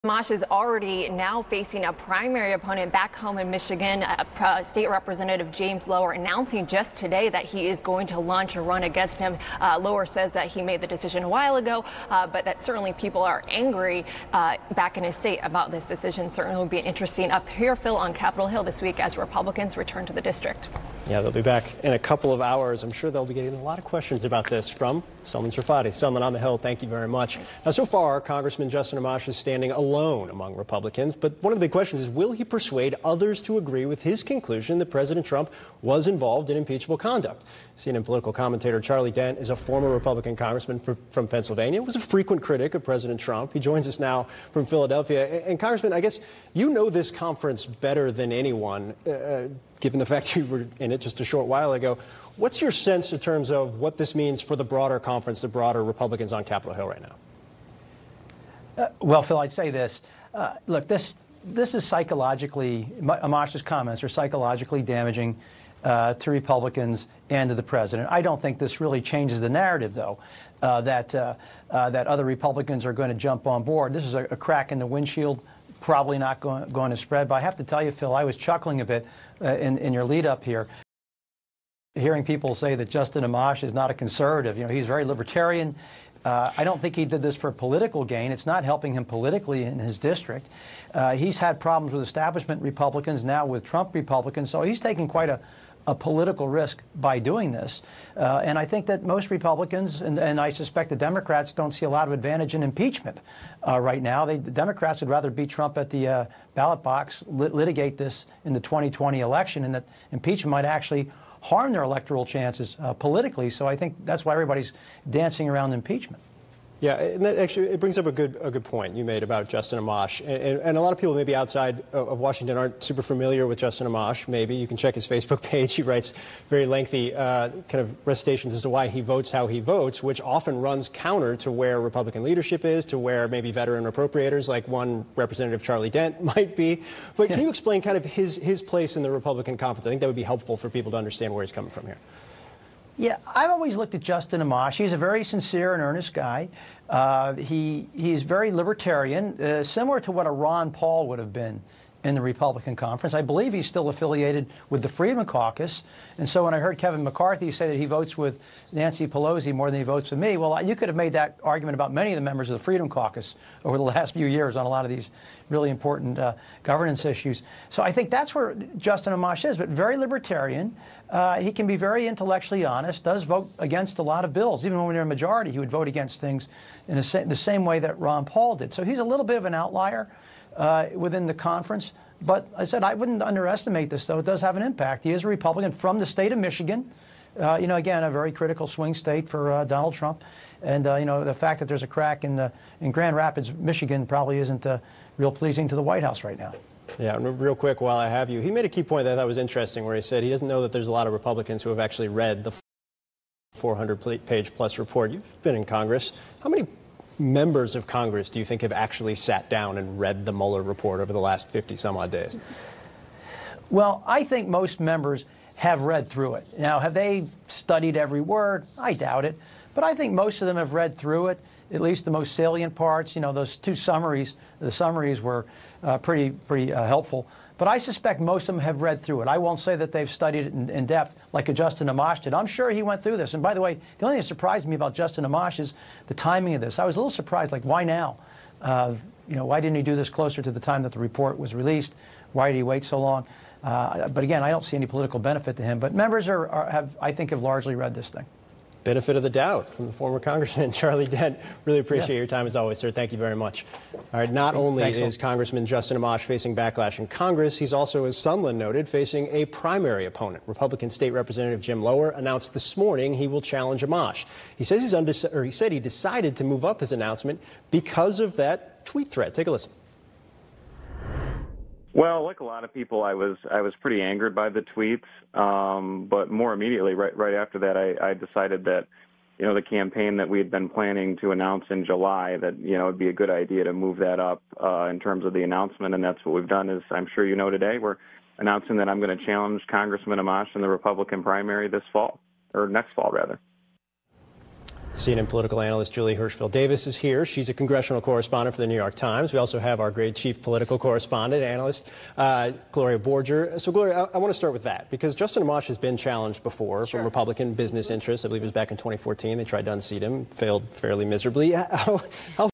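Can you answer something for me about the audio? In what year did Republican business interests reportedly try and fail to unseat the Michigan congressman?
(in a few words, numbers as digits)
2014.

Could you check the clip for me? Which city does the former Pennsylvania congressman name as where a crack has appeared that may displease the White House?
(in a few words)
Grand Rapids.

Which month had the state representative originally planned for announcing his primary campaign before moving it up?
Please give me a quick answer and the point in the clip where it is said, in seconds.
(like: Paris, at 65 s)
July, at 281 s.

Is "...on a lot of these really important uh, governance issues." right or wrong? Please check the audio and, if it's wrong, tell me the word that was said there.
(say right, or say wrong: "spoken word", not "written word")
right.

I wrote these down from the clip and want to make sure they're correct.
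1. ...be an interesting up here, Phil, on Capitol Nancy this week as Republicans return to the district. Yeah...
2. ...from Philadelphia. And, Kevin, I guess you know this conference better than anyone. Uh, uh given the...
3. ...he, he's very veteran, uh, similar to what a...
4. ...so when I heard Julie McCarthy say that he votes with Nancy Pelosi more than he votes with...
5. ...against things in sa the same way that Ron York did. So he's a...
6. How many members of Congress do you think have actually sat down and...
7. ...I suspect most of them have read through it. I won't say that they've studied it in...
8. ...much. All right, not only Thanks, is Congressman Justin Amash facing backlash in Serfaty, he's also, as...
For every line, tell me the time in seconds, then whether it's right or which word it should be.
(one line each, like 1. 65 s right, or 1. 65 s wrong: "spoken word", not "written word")
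1. 16 s wrong: "Hill", not "Nancy"
2. 44 s wrong: "Congressman", not "Kevin"
3. 147 s wrong: "libertarian", not "veteran"
4. 156 s wrong: "Kevin", not "Julie"
5. 175 s wrong: "Paul", not "York"
6. 206 s right
7. 227 s right
8. 253 s wrong: "Congress", not "Serfaty".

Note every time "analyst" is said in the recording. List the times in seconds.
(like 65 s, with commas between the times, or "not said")
295 s, 301 s.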